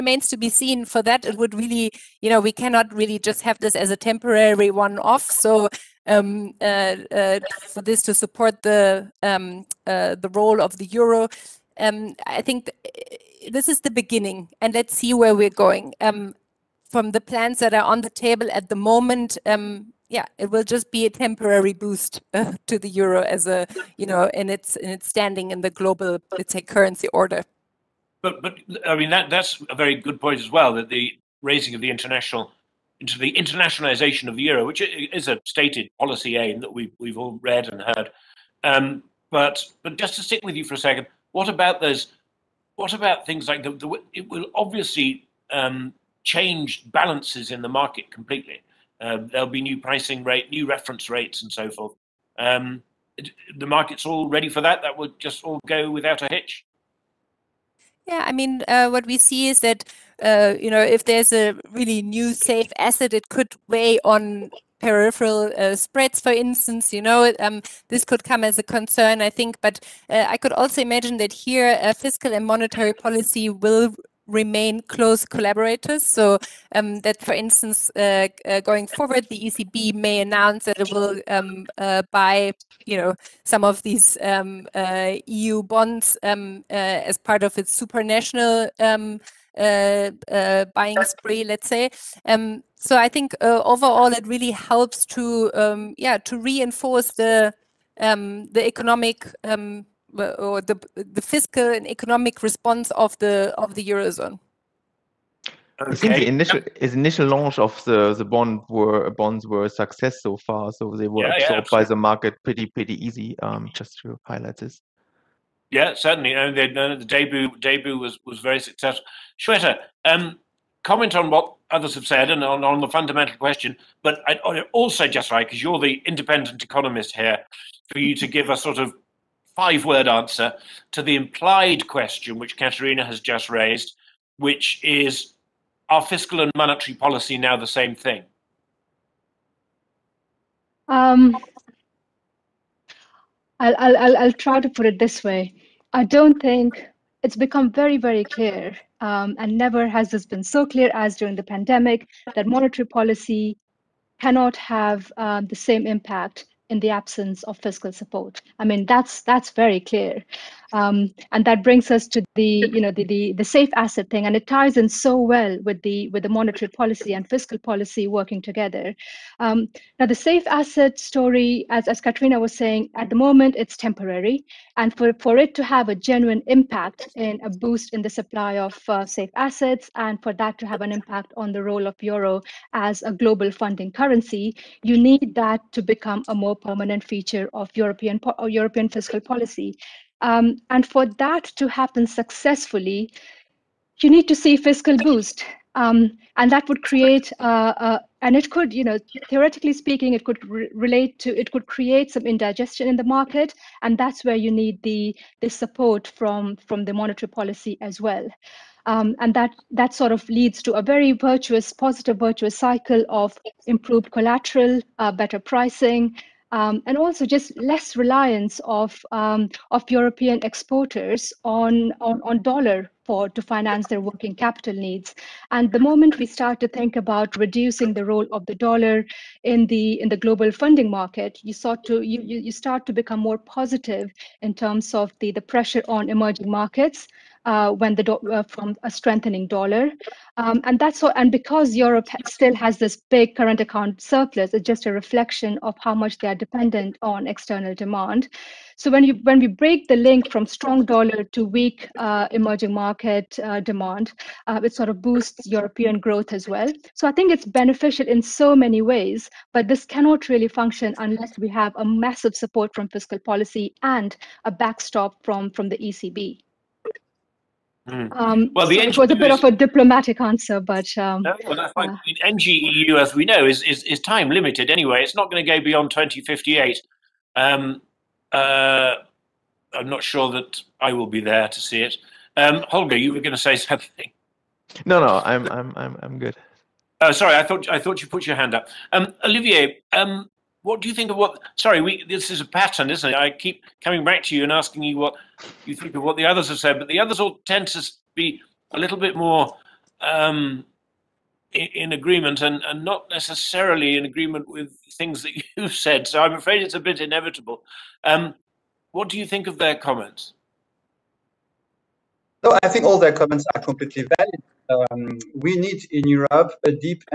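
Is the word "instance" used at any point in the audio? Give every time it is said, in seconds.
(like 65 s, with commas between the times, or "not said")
66 s, 77 s.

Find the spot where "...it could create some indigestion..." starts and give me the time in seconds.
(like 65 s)
201 s.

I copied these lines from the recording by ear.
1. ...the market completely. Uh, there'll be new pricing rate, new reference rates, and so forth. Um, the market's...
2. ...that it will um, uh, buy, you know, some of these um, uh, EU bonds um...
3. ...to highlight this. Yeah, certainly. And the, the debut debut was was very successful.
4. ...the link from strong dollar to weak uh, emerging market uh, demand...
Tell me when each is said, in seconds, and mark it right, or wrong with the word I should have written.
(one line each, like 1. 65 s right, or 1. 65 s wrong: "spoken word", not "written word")
1. 47 s right
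2. 80 s right
3. 114 s right
4. 249 s right.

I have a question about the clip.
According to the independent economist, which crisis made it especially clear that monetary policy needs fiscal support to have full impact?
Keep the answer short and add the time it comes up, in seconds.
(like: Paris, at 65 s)
The pandemic, at 151 s.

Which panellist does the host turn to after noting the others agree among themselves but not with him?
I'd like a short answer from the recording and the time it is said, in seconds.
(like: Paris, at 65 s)
Olivier, at 289 s.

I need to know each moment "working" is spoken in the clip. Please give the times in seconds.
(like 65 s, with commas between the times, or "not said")
168 s, 224 s.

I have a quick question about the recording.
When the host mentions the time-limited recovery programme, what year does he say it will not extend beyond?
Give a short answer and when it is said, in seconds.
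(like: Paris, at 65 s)
2058, at 275 s.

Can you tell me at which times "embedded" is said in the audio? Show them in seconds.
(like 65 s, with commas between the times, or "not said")
not said.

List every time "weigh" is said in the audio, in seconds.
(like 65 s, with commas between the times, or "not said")
63 s.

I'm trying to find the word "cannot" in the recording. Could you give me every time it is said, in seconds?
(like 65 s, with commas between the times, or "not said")
2 s, 154 s, 259 s.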